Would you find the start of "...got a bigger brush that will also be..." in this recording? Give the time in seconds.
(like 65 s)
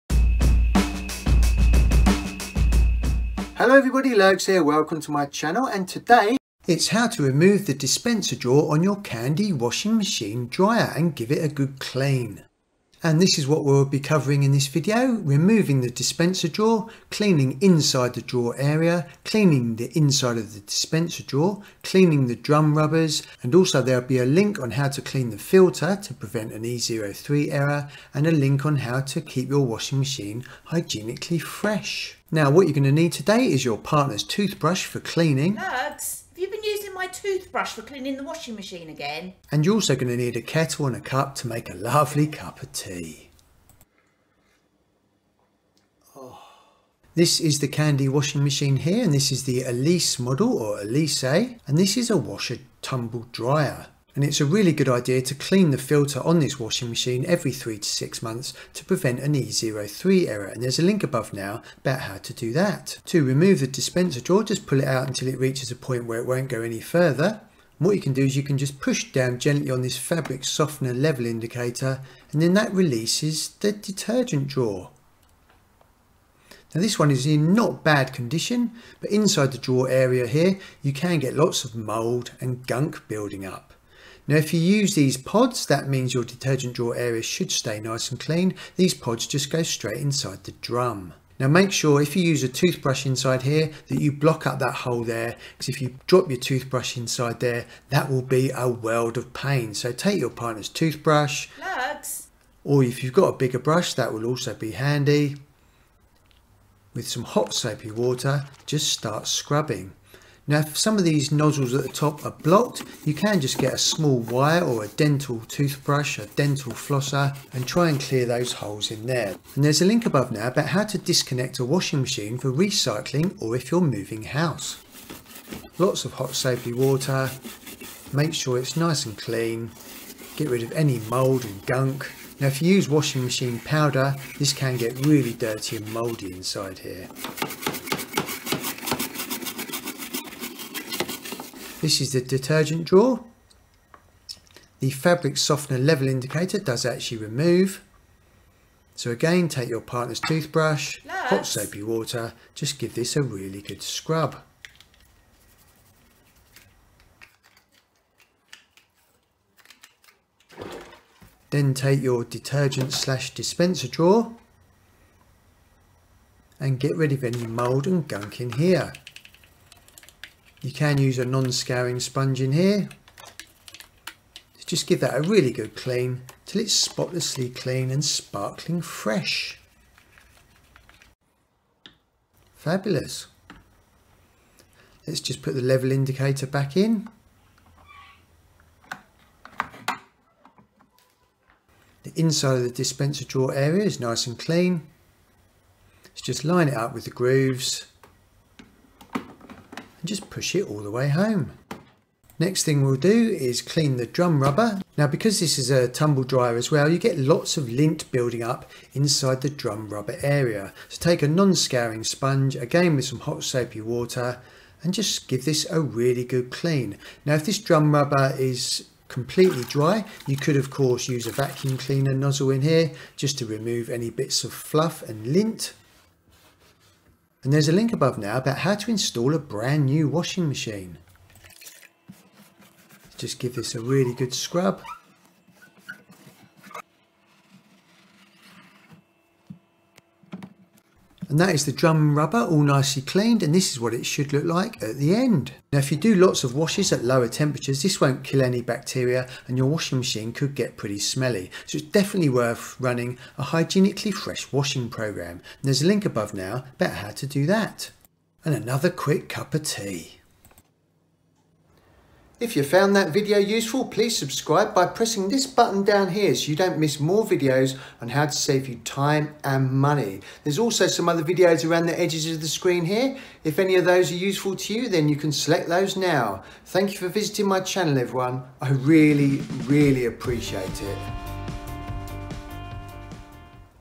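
103 s.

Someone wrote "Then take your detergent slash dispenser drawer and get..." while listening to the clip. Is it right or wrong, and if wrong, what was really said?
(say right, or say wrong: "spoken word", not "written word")
right.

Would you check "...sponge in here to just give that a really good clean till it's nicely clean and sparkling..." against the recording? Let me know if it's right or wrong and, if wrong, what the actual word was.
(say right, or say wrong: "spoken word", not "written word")
wrong: "spotlessly", not "nicely".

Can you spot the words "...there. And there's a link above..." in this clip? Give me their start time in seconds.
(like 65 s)
119 s.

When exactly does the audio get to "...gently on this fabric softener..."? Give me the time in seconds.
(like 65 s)
69 s.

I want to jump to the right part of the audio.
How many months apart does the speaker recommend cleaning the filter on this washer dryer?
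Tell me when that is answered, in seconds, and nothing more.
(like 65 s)
57 s.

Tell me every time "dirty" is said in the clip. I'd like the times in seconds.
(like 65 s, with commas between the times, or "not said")
135 s.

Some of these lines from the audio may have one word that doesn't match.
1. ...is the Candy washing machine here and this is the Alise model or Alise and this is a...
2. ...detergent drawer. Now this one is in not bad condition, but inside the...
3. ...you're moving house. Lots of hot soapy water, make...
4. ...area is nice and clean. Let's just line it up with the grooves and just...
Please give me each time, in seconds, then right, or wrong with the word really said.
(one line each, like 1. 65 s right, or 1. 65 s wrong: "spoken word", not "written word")
1. 47 s right
2. 73 s right
3. 123 s right
4. 193 s right.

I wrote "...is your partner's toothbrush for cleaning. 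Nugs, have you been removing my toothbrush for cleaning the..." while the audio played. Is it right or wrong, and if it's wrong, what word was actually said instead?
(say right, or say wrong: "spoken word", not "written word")
wrong: "using", not "removing".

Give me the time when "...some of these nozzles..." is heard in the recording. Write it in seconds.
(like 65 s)
110 s.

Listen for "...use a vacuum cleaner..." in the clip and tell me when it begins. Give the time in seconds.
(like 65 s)
221 s.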